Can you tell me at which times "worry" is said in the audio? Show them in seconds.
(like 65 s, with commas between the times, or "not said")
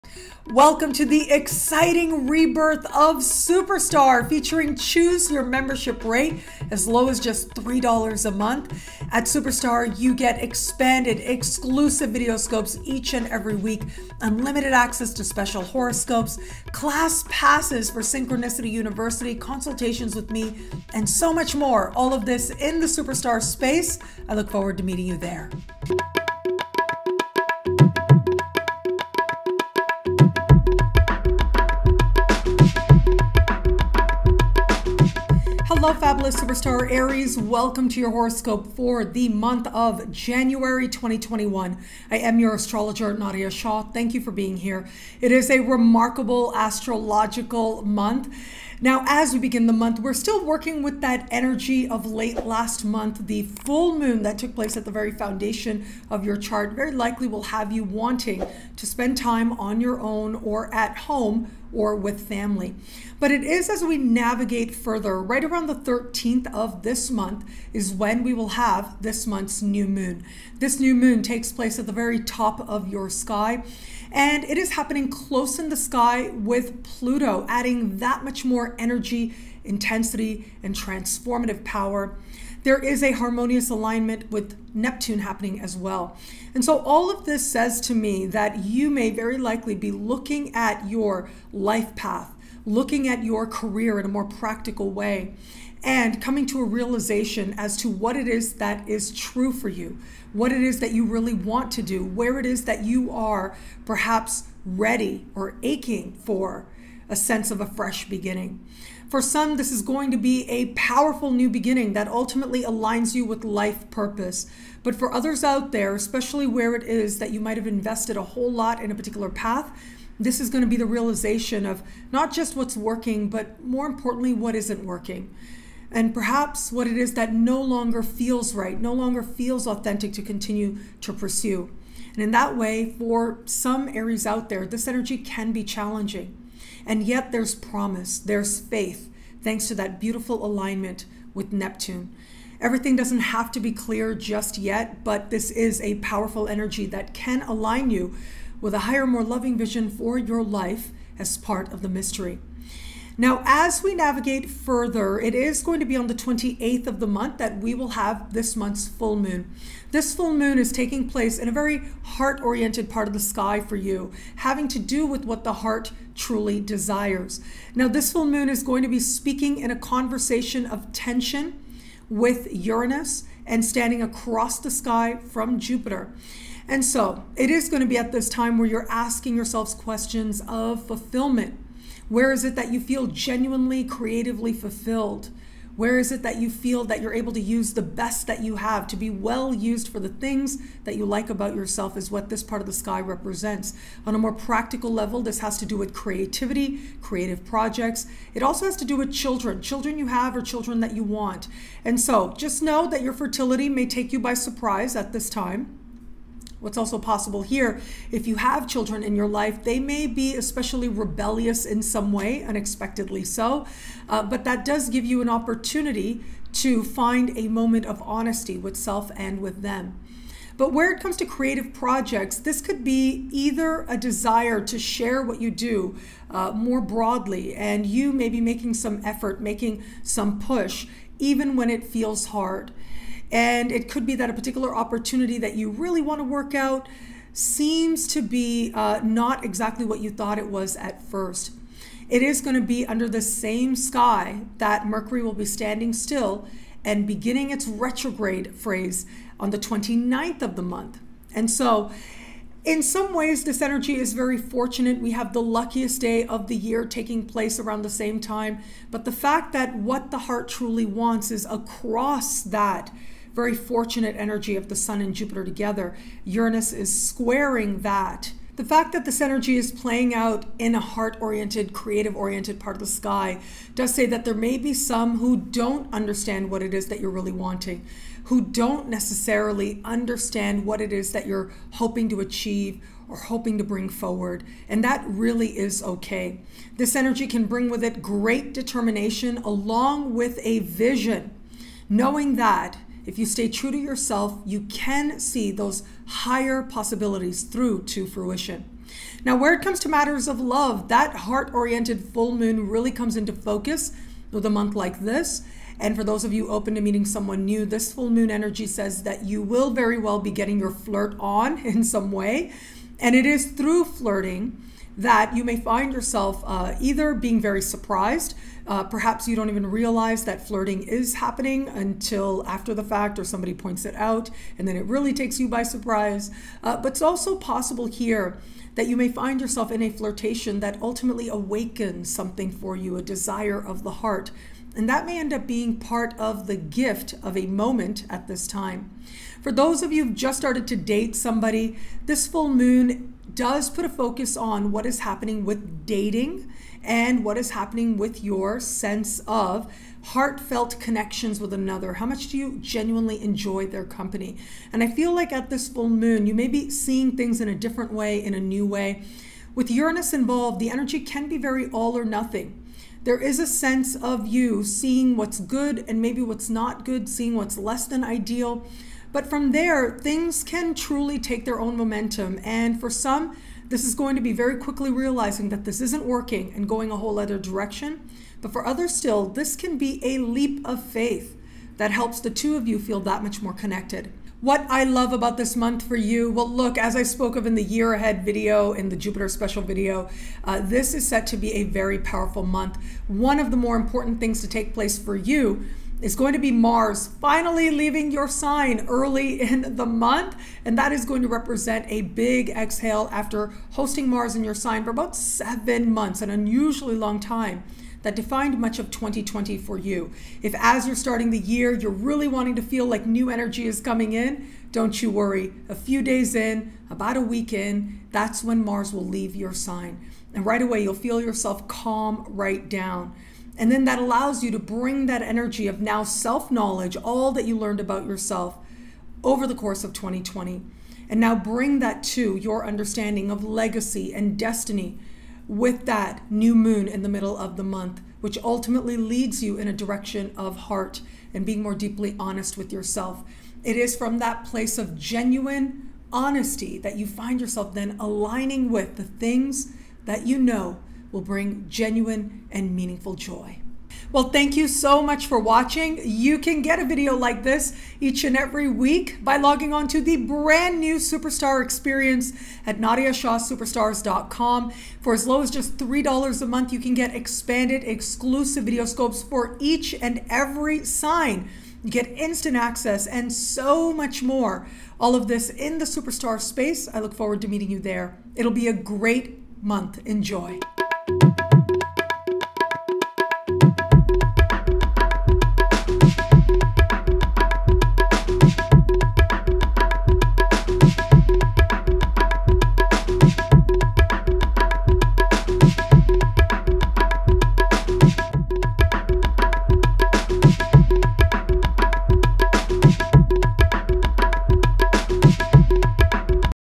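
415 s.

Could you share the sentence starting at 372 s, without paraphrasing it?
And for some, this is going to be very quickly realizing that this isn't working and going a whole other direction.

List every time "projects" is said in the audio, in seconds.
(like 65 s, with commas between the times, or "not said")
197 s, 221 s.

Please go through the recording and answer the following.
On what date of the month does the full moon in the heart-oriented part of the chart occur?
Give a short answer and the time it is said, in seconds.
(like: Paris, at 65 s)
28th, at 156 s.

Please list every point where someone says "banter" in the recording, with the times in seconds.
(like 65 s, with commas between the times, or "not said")
not said.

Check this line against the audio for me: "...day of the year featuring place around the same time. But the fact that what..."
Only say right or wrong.
wrong.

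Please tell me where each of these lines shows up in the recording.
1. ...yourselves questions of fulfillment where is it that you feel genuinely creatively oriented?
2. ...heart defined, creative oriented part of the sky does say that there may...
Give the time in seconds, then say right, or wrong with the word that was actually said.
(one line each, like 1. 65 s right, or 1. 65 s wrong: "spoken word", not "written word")
1. 179 s wrong: "fulfilled", not "oriented"
2. 270 s wrong: "oriented", not "defined".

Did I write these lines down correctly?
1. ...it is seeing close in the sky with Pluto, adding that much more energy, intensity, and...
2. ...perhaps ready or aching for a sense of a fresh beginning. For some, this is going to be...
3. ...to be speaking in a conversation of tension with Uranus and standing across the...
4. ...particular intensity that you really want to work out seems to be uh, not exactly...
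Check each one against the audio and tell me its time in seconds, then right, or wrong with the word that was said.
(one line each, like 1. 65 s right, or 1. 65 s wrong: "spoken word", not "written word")
1. 74 s wrong: "happening", not "seeing"
2. 103 s right
3. 168 s right
4. 234 s wrong: "opportunity", not "intensity".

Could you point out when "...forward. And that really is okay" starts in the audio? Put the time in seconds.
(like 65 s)
283 s.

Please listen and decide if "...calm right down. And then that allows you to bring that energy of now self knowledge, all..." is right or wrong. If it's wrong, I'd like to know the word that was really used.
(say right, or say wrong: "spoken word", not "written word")
right.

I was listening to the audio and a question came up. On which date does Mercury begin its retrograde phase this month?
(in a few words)
29th.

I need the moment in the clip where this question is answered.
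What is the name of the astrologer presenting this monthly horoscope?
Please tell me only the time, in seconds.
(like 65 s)
43 s.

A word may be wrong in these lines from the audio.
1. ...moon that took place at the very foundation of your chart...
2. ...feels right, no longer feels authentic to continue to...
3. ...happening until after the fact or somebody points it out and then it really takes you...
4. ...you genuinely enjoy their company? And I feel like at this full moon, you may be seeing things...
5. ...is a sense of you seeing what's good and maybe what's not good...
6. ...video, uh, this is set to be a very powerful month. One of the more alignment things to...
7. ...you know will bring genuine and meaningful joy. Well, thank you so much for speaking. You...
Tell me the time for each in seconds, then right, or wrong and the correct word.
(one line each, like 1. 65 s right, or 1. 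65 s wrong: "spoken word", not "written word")
1. 53 s right
2. 128 s right
3. 321 s right
4. 352 s right
5. 363 s right
6. 389 s wrong: "important", not "alignment"
7. 450 s wrong: "watching", not "speaking".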